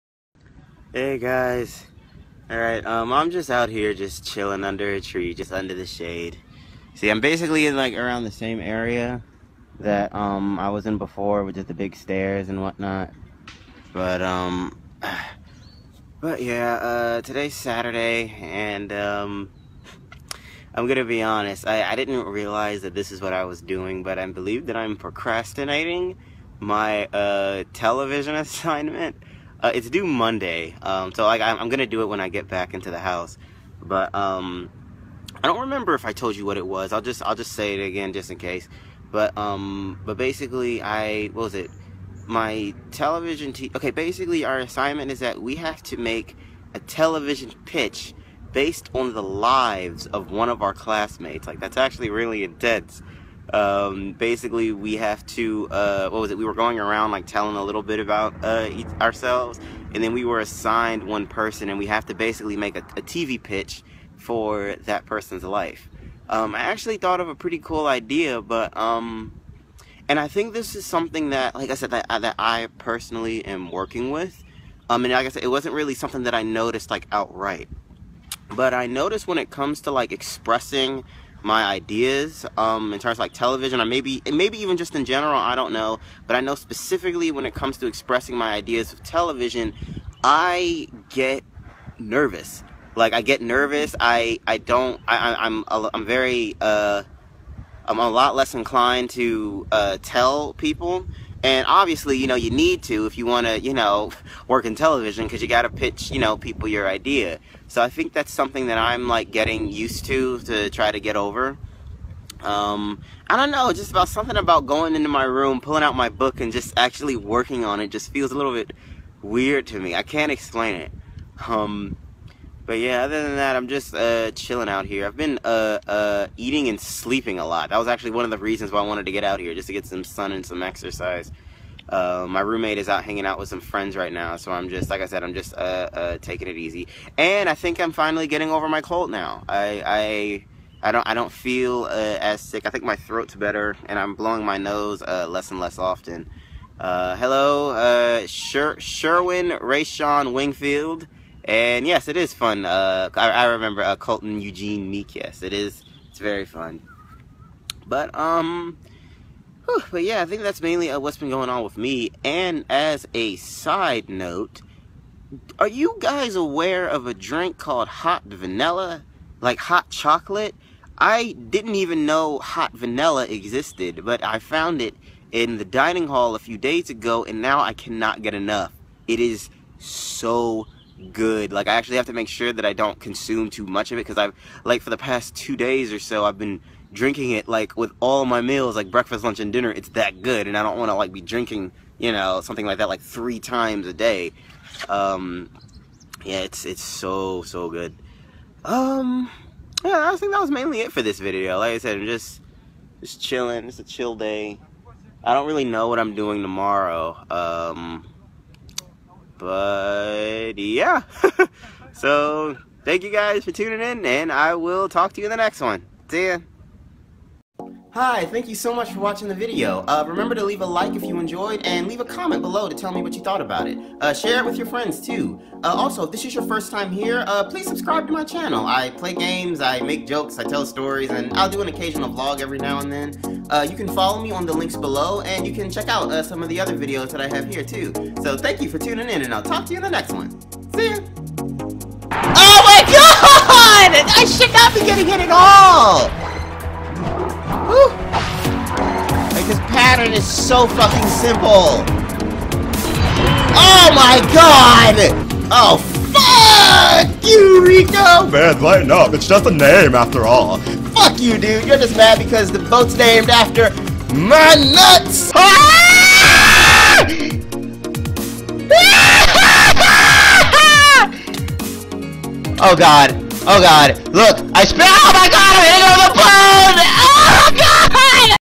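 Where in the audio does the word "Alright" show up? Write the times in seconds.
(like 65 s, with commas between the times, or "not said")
2 s.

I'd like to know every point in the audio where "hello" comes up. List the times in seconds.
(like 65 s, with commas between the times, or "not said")
147 s.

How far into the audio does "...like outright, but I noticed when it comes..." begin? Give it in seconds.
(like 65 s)
76 s.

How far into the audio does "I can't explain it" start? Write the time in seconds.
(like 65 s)
119 s.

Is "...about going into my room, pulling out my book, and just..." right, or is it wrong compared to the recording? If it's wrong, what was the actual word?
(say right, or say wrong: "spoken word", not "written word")
right.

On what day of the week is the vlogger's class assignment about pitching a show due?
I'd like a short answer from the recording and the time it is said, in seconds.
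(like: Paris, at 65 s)
Monday, at 29 s.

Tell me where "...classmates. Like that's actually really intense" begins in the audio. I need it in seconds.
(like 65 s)
50 s.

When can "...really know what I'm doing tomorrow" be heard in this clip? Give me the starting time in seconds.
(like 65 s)
205 s.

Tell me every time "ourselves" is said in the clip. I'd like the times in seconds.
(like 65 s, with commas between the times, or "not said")
59 s.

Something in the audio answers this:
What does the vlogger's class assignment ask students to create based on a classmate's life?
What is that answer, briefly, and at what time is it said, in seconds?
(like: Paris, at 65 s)
television pitch, at 46 s.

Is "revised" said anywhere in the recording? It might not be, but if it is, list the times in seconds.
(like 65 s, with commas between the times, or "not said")
not said.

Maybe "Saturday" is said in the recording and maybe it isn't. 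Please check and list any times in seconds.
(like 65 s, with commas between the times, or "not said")
17 s.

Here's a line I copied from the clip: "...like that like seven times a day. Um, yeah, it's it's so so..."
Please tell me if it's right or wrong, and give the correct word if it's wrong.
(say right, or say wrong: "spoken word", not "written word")
wrong: "three", not "seven".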